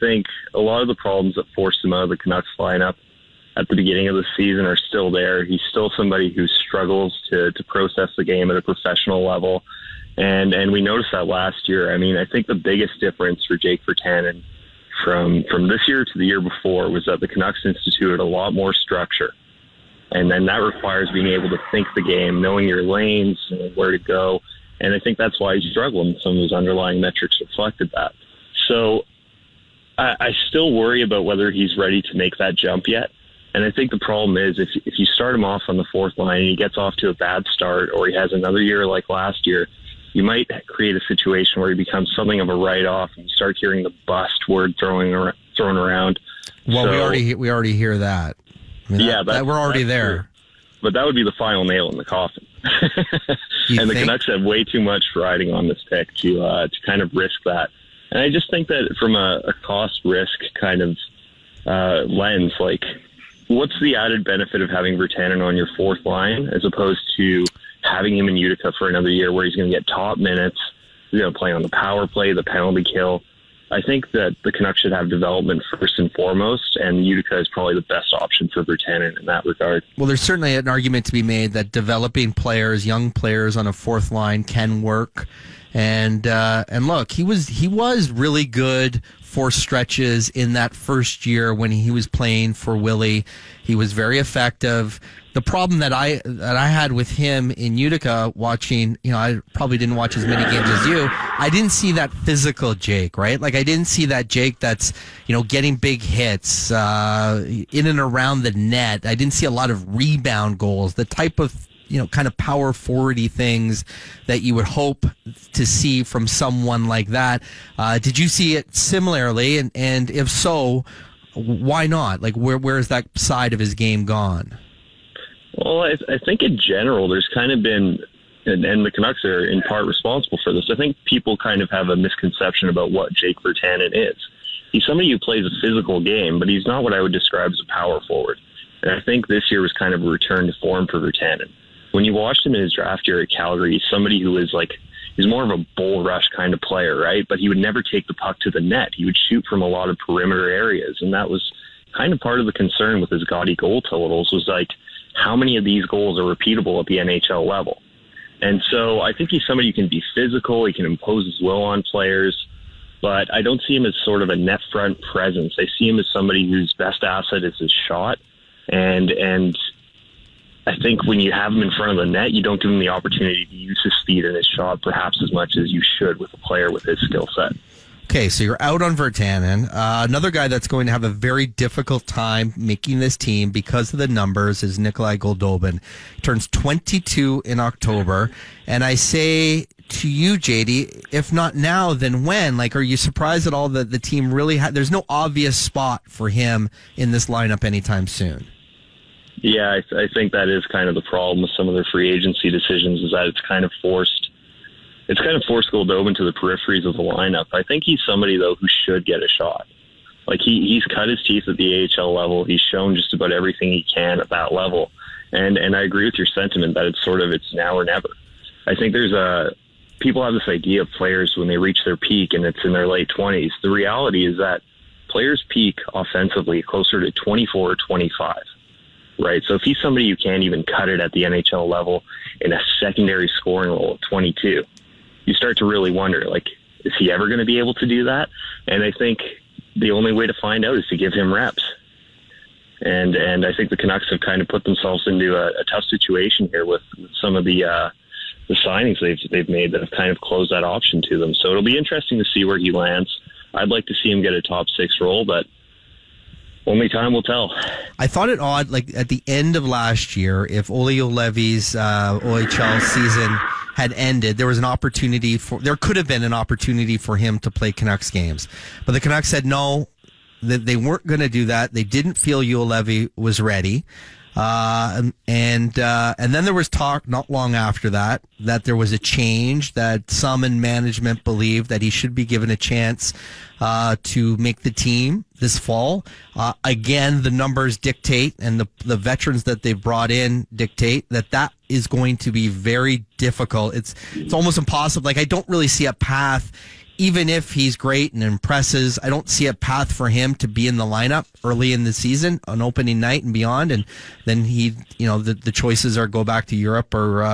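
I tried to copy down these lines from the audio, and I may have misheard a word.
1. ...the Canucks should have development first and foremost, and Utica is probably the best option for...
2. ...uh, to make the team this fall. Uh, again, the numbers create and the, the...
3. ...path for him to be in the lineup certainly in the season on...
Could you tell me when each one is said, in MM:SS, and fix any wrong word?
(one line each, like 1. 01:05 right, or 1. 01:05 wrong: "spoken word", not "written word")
1. 01:14 right
2. 04:43 wrong: "dictate", not "create"
3. 04:59 wrong: "early", not "certainly".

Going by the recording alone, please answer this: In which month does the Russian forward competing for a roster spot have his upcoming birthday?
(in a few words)
October.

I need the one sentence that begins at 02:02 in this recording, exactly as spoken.
Like where where is that side of his game gone?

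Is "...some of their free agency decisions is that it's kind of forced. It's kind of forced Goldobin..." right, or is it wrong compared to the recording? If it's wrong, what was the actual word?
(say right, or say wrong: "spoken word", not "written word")
right.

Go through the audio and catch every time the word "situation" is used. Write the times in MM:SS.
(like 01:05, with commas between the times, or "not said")
00:41, 04:05.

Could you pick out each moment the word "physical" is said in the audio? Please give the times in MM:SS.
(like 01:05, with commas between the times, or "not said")
01:42, 02:15, 02:40.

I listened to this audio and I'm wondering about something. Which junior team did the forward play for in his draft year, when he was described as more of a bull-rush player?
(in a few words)
Calgary.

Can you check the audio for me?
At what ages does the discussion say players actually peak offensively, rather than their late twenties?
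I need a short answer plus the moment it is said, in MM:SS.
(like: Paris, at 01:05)
24 or 25, at 03:47.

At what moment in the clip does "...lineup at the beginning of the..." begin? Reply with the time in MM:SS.
00:02.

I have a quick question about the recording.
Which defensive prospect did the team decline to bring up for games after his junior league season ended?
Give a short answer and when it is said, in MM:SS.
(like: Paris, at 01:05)
Olli Juolevi, at 04:20.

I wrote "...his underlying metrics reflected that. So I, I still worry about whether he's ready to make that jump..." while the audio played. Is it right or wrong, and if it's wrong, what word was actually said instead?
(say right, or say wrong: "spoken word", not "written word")
right.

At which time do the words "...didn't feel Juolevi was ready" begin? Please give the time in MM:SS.
04:31.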